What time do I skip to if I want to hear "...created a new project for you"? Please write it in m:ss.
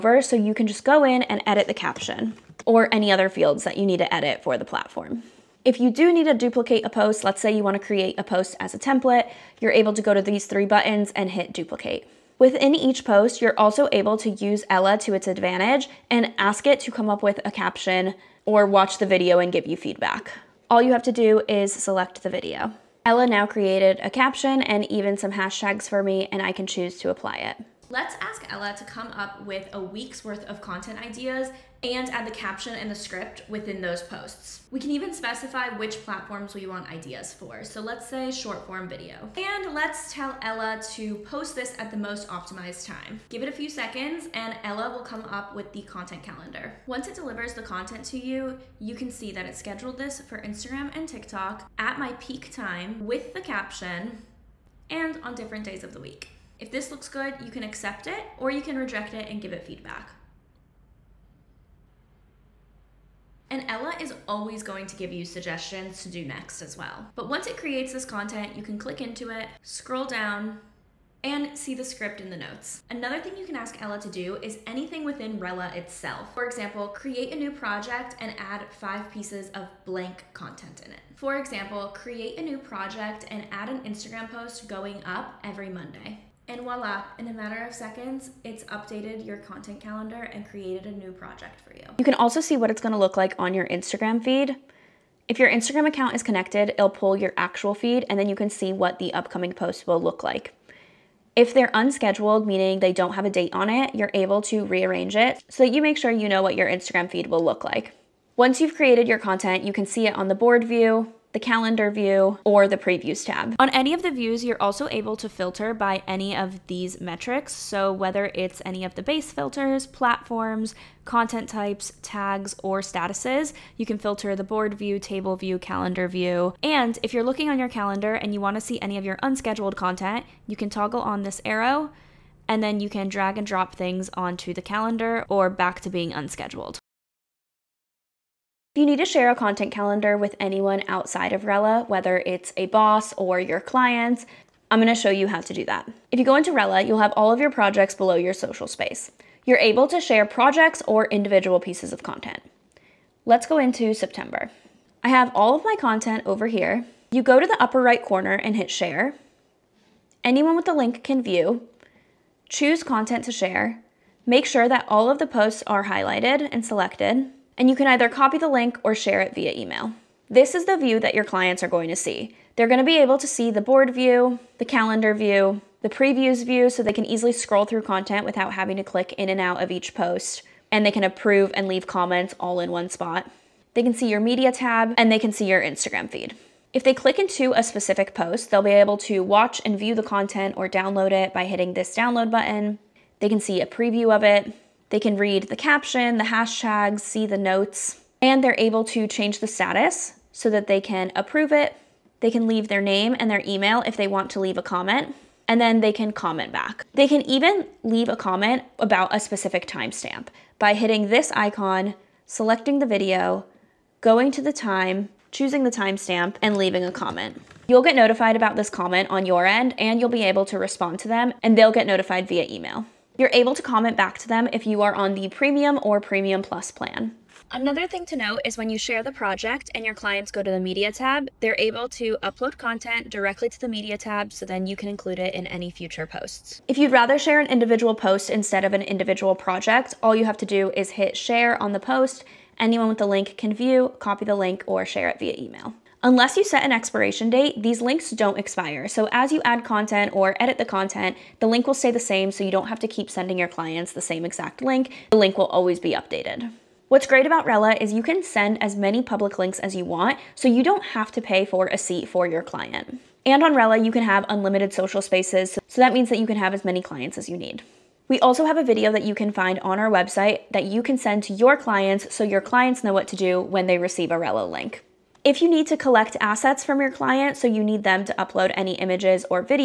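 1:30.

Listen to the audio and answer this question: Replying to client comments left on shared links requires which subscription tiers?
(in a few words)
Premium or Premium Plus.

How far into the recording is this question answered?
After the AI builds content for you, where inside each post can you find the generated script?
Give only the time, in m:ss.
1:12.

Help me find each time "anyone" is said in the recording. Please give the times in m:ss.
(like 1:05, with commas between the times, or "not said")
2:20, 2:40, 4:02.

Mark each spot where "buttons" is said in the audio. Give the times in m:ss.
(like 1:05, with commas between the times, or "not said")
0:10, 3:12.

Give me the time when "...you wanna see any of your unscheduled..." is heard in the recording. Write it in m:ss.
2:08.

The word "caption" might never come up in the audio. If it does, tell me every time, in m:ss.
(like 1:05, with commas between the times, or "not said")
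0:01, 0:17, 0:24, 0:32, 0:53, 3:15.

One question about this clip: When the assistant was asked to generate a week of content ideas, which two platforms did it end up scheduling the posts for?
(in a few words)
Instagram and TikTok.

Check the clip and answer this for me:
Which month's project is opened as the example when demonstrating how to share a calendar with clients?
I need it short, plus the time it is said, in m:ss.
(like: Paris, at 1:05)
September, at 2:33.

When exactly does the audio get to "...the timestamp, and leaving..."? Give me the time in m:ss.
3:35.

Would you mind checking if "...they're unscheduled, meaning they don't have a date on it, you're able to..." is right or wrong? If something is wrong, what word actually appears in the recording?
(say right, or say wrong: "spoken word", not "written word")
right.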